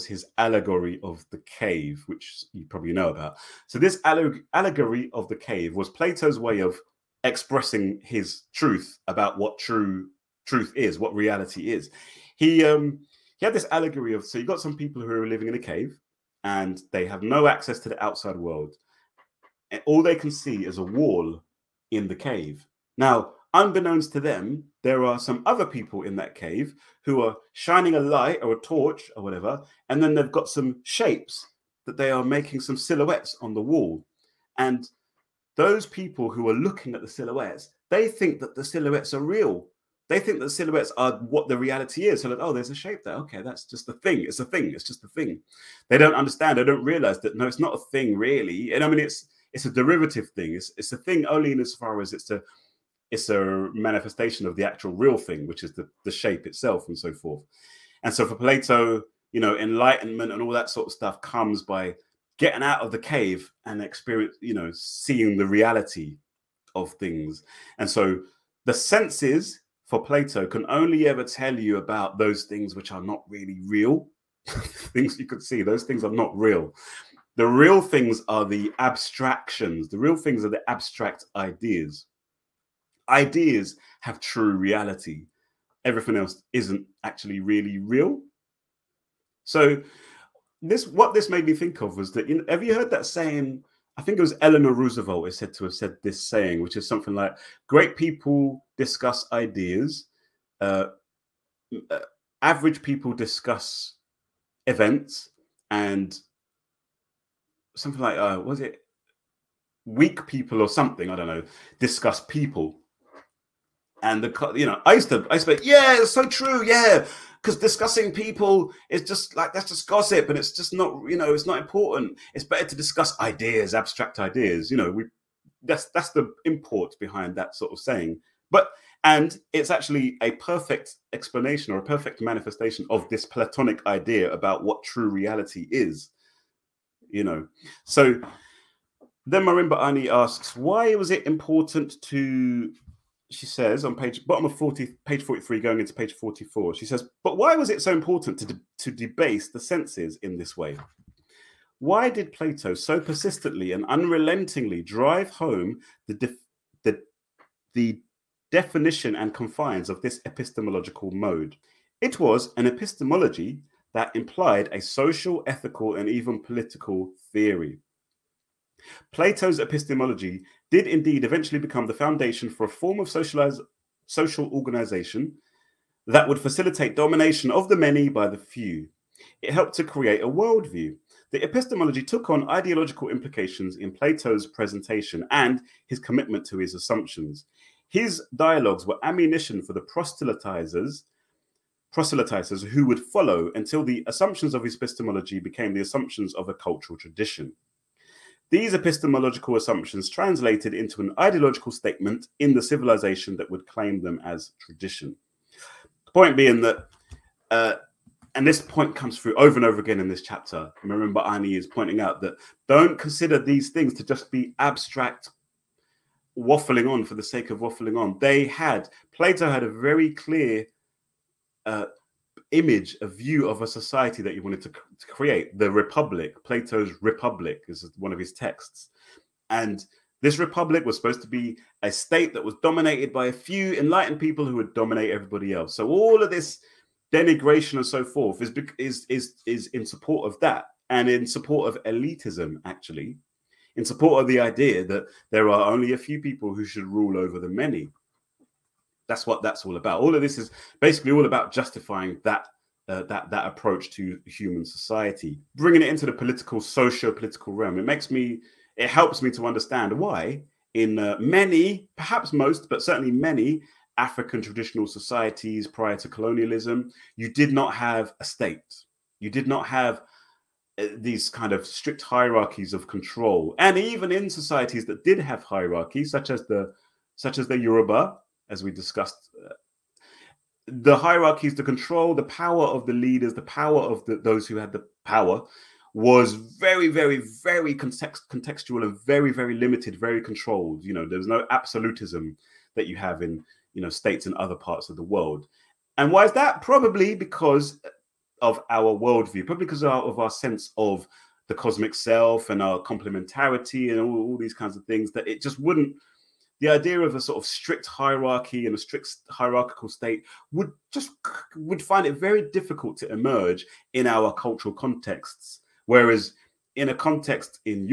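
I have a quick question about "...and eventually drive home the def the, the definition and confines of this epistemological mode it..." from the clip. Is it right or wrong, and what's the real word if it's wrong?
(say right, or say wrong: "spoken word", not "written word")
wrong: "unrelentingly", not "eventually".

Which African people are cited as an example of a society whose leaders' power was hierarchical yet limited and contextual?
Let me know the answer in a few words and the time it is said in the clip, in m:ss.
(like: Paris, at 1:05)
Yoruba, at 4:37.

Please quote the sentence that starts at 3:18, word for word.
These epistemological assumptions translated into an ideological statement in the civilization that would claim them as tradition.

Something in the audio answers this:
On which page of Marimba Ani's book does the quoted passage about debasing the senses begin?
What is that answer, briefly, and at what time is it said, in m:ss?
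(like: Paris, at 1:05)
43, at 2:25.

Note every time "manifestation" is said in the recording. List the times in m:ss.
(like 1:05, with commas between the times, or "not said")
0:53, 2:12.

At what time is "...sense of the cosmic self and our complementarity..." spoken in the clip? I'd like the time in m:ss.
5:00.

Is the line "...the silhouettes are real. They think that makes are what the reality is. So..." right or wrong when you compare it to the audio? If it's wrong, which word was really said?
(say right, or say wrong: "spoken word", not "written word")
wrong: "silhouettes", not "makes".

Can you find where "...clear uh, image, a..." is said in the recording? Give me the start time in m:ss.
3:40.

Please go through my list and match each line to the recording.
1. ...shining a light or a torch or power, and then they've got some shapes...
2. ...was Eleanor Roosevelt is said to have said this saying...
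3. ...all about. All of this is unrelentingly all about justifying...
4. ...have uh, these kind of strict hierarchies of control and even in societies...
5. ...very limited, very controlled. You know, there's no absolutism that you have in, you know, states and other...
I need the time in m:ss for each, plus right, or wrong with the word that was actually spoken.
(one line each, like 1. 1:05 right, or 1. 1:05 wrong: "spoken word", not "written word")
1. 0:27 wrong: "whatever", not "power"
2. 1:34 right
3. 4:09 wrong: "basically", not "unrelentingly"
4. 4:29 right
5. 4:49 right.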